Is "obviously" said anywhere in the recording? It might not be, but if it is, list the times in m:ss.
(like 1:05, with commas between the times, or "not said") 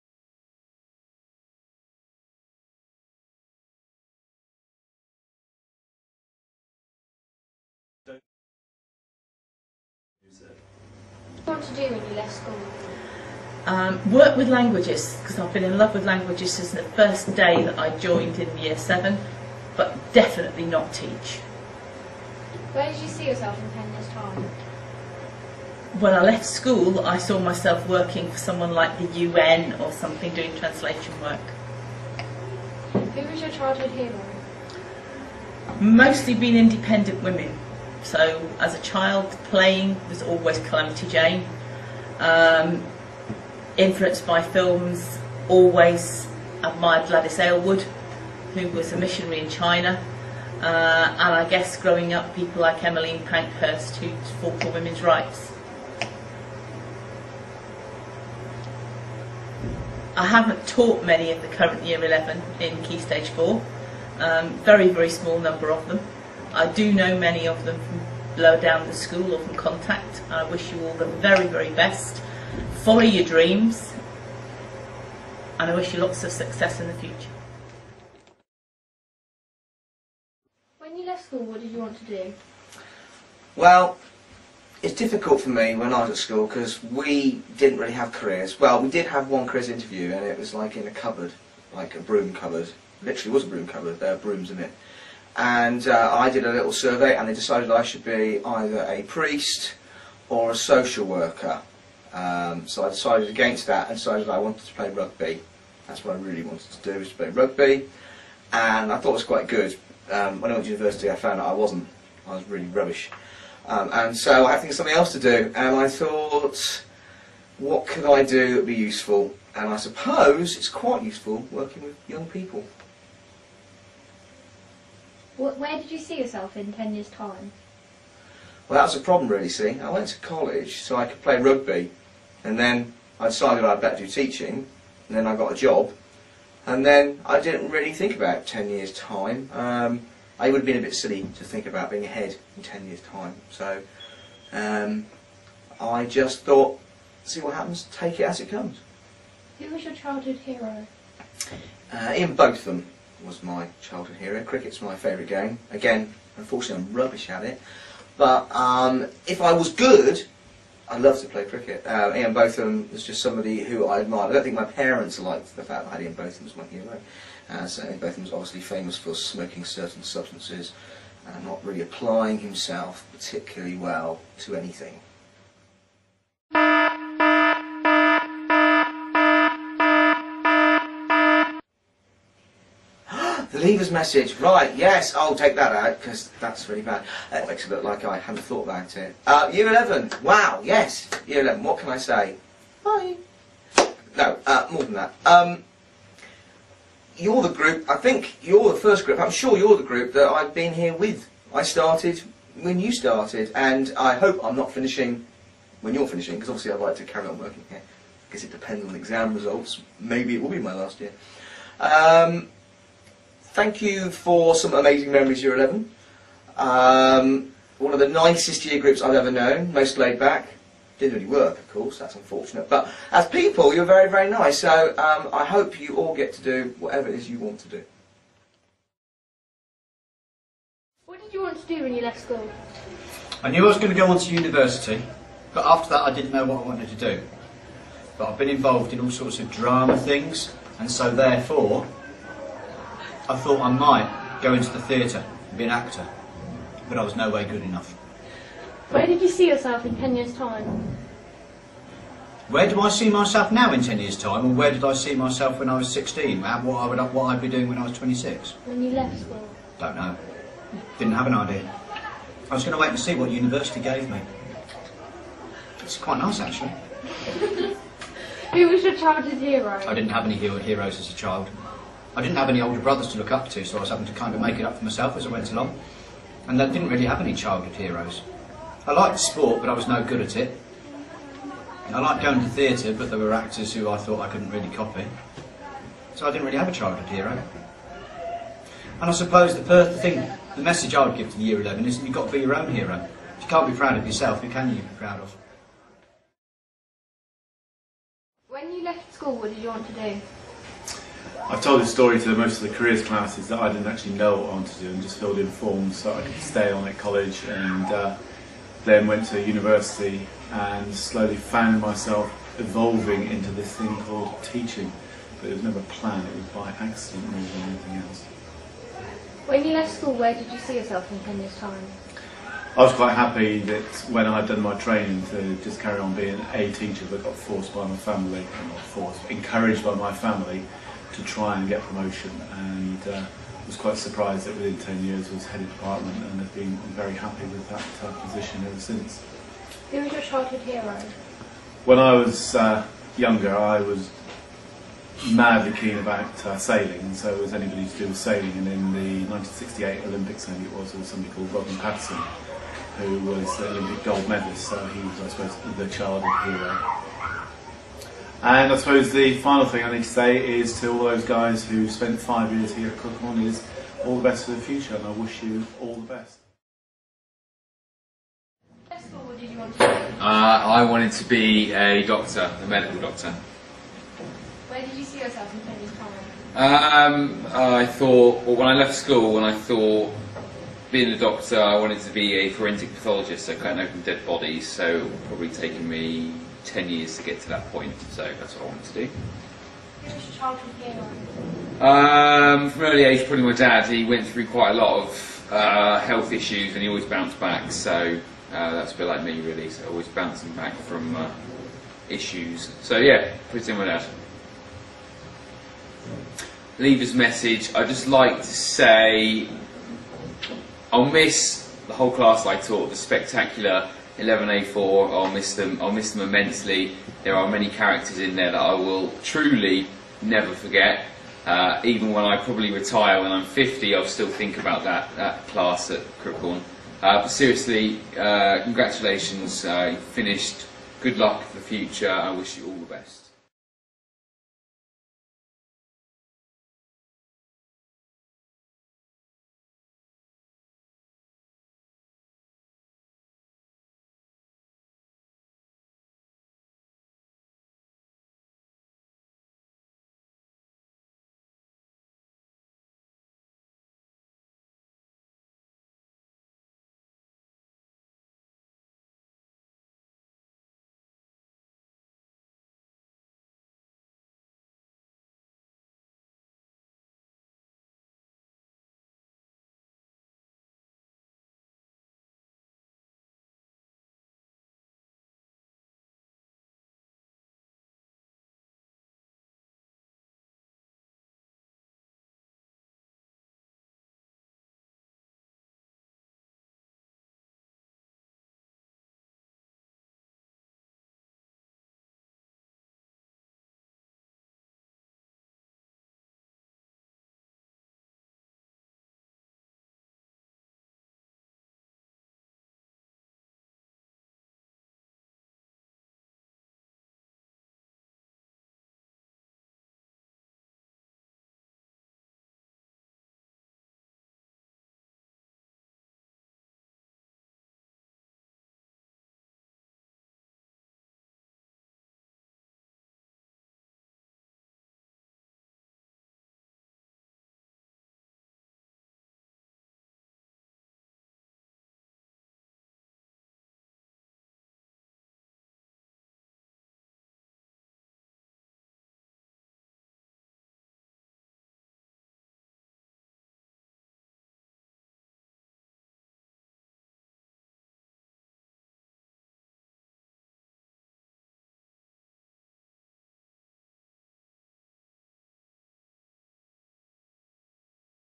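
2:48, 3:26.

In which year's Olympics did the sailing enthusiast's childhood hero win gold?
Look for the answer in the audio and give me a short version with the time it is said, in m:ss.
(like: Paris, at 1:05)
1968, at 5:49.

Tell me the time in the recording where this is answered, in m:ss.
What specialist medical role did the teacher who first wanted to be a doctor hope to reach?
6:22.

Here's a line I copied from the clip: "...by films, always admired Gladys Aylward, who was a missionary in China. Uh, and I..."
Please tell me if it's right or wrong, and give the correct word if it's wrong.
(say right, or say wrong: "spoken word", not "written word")
right.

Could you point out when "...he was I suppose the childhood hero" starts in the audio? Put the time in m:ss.
5:54.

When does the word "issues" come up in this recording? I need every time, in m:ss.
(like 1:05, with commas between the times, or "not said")
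6:36, 6:42.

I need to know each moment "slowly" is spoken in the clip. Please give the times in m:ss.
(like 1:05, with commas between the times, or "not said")
5:10.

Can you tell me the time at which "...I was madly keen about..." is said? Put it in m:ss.
5:43.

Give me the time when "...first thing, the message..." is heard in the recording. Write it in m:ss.
4:49.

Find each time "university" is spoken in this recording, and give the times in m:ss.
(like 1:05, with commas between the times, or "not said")
1:50, 3:54, 4:23, 5:09.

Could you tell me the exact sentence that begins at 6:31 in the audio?
Um, from early age, probably my dad.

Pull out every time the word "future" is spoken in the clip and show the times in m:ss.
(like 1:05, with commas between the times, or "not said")
1:16, 6:04, 7:11.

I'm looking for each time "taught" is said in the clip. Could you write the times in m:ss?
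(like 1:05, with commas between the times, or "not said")
1:00, 6:52.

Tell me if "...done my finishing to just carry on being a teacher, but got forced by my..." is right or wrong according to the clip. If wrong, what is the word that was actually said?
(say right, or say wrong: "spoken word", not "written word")
wrong: "training", not "finishing".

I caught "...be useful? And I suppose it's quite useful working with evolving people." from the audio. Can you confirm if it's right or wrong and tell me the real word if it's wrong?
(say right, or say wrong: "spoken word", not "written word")
wrong: "young", not "evolving".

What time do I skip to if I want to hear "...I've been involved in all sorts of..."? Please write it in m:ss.
3:58.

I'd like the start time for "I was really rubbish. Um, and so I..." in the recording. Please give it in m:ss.
1:52.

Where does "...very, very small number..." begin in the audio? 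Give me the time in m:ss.
1:04.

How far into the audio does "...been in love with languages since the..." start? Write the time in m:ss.
0:15.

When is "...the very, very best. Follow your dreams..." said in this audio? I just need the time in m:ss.
1:10.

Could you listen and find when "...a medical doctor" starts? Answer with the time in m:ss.
6:12.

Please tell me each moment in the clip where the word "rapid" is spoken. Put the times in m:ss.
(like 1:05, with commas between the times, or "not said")
not said.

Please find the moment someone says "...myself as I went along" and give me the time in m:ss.
4:34.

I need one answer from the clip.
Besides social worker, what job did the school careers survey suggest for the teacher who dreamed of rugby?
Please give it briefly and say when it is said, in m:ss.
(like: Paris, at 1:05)
Priest, at 1:38.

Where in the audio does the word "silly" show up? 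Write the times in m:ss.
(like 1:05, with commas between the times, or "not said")
2:20.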